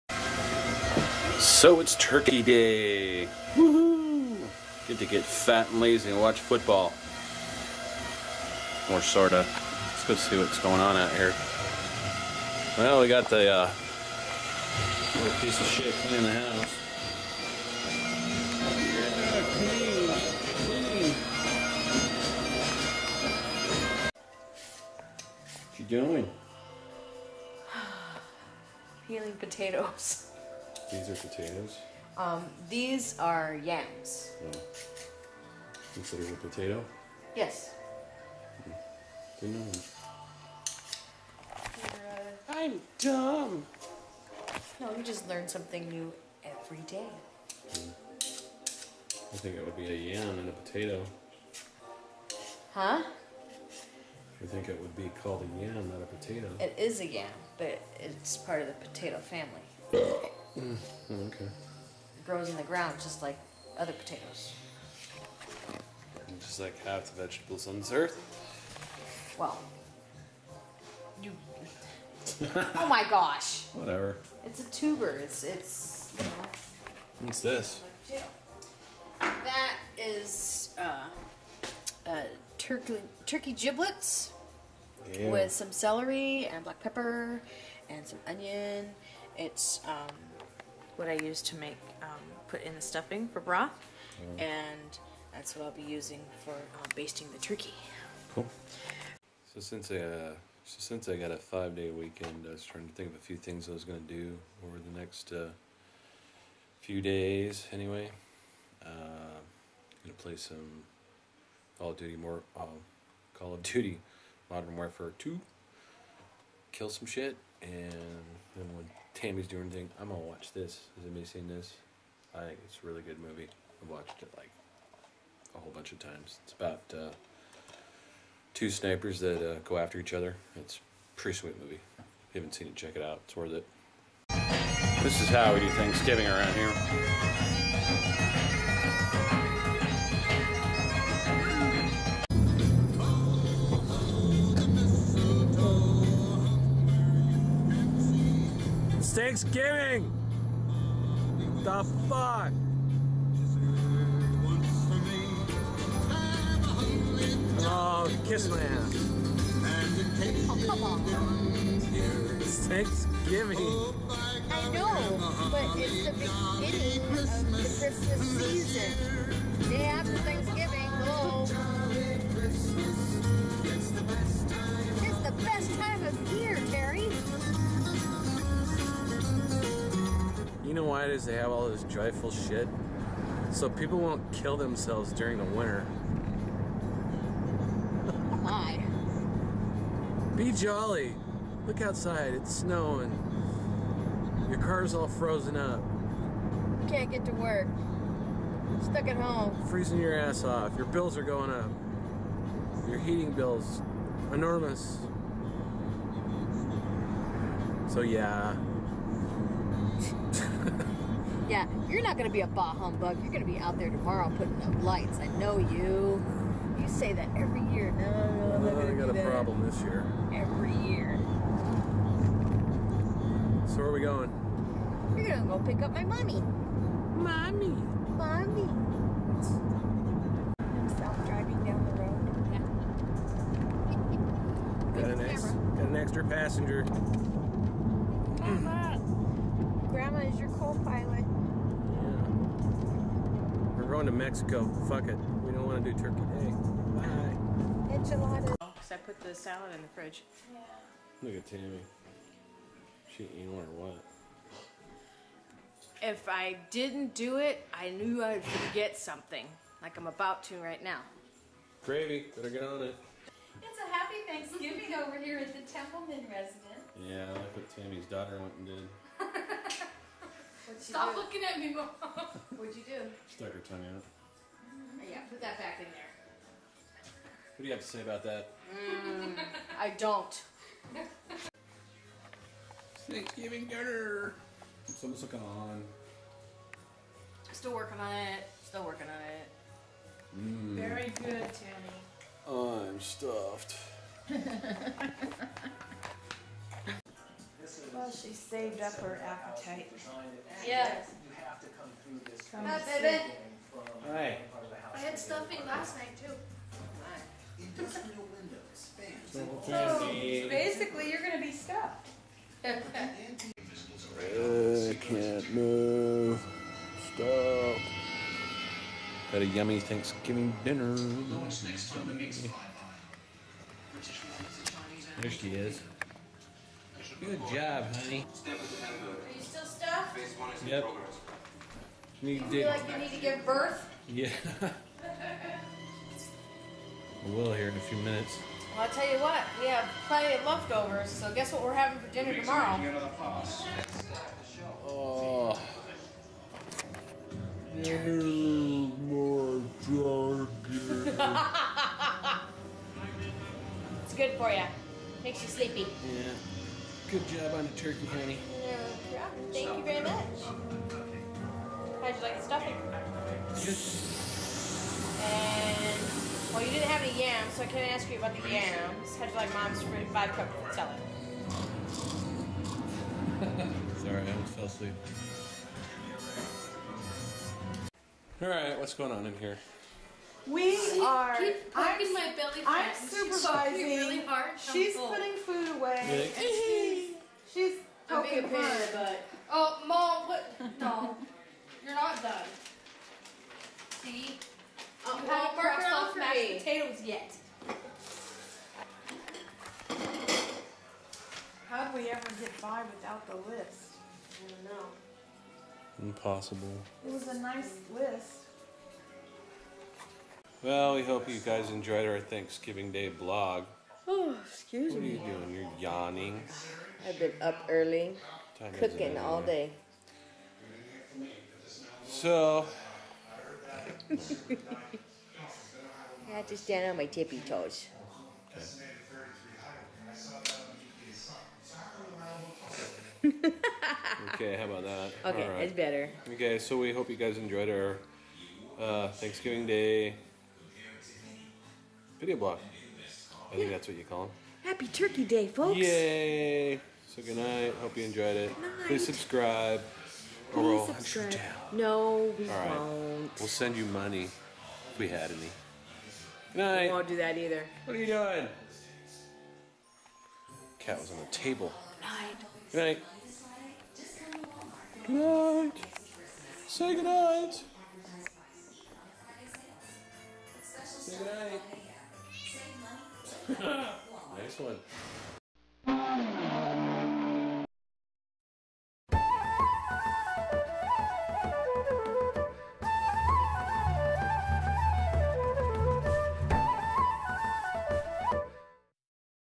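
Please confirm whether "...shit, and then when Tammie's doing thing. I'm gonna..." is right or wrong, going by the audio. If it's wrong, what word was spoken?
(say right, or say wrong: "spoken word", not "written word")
right.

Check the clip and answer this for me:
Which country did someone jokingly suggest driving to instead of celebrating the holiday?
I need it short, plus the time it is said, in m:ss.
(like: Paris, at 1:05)
Mexico, at 4:04.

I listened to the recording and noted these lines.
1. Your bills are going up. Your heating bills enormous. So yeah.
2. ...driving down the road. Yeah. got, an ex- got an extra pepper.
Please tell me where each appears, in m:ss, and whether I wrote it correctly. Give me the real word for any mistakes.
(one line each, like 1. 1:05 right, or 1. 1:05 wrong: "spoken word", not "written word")
1. 3:20 right
2. 3:51 wrong: "passenger", not "pepper".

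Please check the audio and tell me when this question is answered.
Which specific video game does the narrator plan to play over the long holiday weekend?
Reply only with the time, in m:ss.
1:53.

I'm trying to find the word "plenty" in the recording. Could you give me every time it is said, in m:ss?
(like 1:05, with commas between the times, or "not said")
5:40.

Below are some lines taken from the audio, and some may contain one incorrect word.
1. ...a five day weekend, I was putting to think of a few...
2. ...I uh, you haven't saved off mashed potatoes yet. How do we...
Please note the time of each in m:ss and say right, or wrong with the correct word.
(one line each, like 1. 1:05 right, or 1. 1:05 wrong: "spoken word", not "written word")
1. 1:41 wrong: "trying", not "putting"
2. 6:35 wrong: "crossed", not "saved".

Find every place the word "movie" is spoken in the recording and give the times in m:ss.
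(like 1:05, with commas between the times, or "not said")
2:03, 2:11.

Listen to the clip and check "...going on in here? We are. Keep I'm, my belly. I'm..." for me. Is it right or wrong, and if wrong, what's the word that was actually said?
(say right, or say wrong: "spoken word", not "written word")
right.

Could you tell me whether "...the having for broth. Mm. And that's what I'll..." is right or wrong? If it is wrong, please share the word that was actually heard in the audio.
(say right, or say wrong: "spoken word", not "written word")
wrong: "stuffing", not "having".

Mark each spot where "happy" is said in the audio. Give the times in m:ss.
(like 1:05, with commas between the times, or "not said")
4:23, 7:24.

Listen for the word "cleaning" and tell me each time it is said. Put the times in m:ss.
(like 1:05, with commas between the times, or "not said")
0:15.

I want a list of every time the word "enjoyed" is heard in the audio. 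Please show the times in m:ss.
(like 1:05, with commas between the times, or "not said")
6:51, 7:17, 7:28.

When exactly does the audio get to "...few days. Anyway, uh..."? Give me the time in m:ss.
1:46.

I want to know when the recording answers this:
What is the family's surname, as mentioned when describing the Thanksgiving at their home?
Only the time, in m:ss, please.
4:25.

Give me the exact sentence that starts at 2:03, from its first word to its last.
I've watched it like a whole bunch of times.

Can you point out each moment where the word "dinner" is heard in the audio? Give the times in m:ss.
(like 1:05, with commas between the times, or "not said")
4:43, 5:20, 5:42.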